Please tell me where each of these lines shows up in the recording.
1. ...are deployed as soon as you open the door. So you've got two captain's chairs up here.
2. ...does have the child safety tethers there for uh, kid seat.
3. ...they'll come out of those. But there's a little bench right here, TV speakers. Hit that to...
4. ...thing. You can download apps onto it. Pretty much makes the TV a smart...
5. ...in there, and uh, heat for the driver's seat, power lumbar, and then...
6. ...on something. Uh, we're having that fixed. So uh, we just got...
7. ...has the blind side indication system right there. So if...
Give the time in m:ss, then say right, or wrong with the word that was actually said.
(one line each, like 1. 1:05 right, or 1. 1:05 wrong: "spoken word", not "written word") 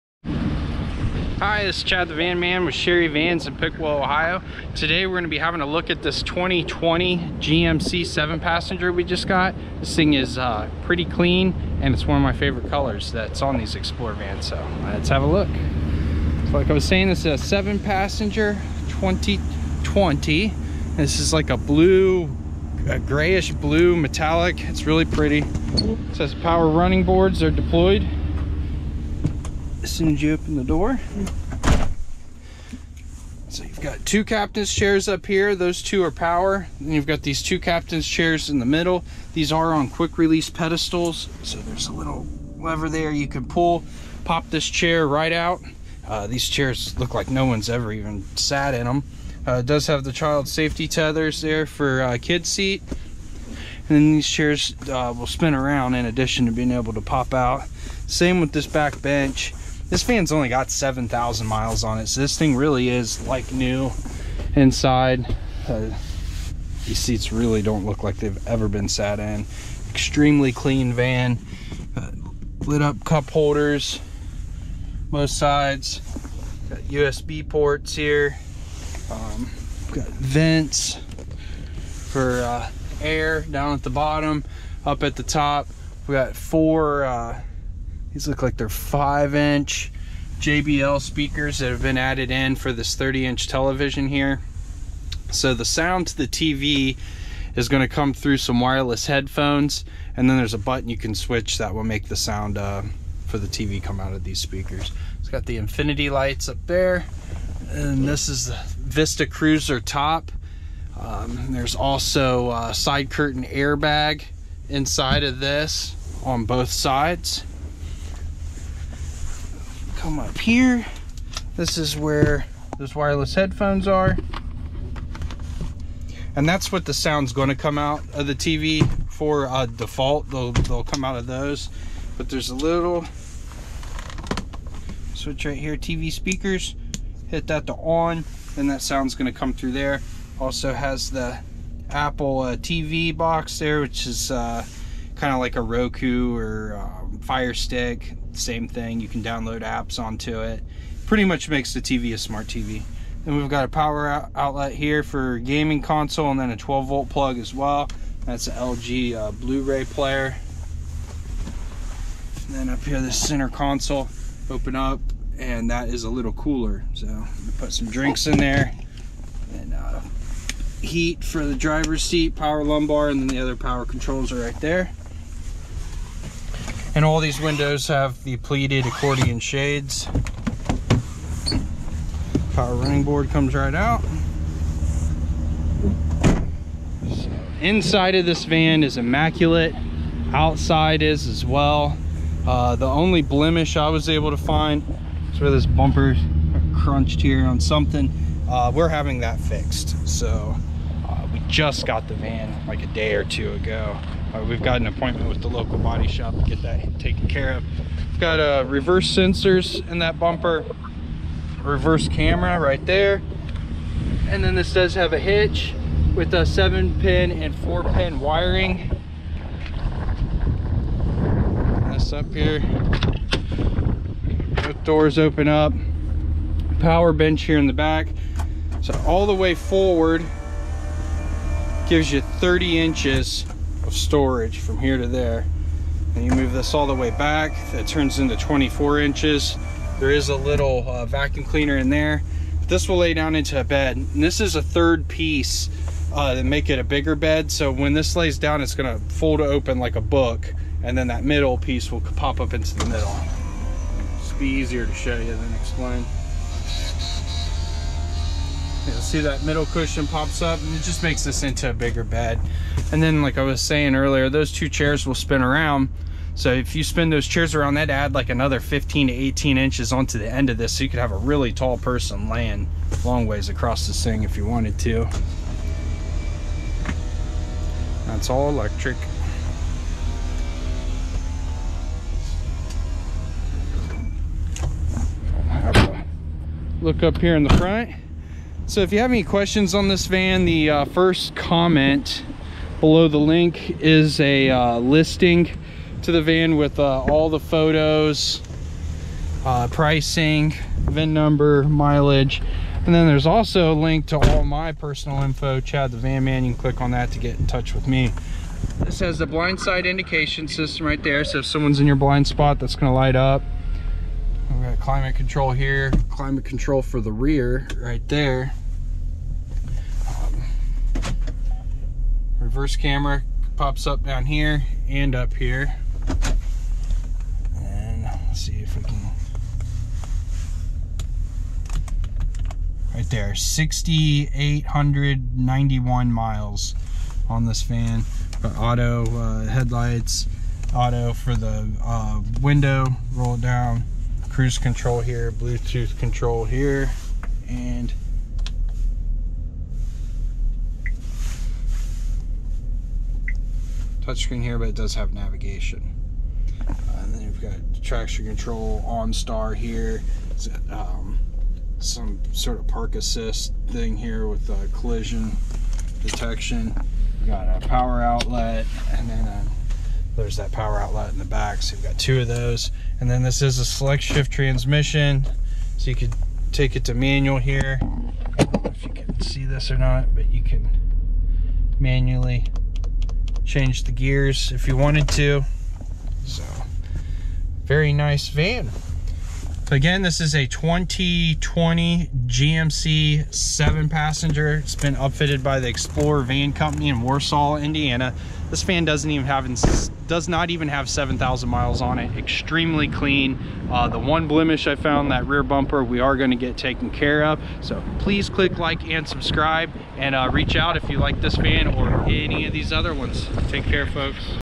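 1. 0:27 right
2. 0:49 right
3. 2:10 wrong: "switch", not "bench"
4. 2:28 right
5. 2:48 right
6. 3:17 right
7. 5:09 right.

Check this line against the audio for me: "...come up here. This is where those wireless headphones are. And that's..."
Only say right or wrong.
right.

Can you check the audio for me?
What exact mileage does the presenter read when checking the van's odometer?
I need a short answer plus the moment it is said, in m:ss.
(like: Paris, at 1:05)
6,891 miles, at 5:33.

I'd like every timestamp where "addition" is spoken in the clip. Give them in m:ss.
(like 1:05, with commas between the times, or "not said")
0:56.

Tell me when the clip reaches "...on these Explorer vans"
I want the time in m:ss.
0:13.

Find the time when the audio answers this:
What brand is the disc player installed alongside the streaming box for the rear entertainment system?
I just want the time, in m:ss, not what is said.
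2:38.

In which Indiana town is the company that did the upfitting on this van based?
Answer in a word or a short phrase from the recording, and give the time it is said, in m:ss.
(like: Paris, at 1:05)
Warsaw, at 6:37.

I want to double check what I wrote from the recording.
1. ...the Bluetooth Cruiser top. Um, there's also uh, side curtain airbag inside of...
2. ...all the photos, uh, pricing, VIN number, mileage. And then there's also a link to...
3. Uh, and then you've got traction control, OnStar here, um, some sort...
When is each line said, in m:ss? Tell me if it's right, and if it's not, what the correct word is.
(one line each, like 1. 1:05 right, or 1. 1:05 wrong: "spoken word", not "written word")
1. 1:48 wrong: "Vista", not "Bluetooth"
2. 4:57 right
3. 5:56 right.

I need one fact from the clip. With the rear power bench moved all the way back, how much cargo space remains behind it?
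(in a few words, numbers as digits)
24 inches.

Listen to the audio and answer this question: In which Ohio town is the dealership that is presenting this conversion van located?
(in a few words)
Piqua.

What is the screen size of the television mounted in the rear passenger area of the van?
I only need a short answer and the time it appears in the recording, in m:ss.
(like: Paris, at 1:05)
30 inch, at 1:32.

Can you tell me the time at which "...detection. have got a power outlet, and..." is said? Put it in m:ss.
6:06.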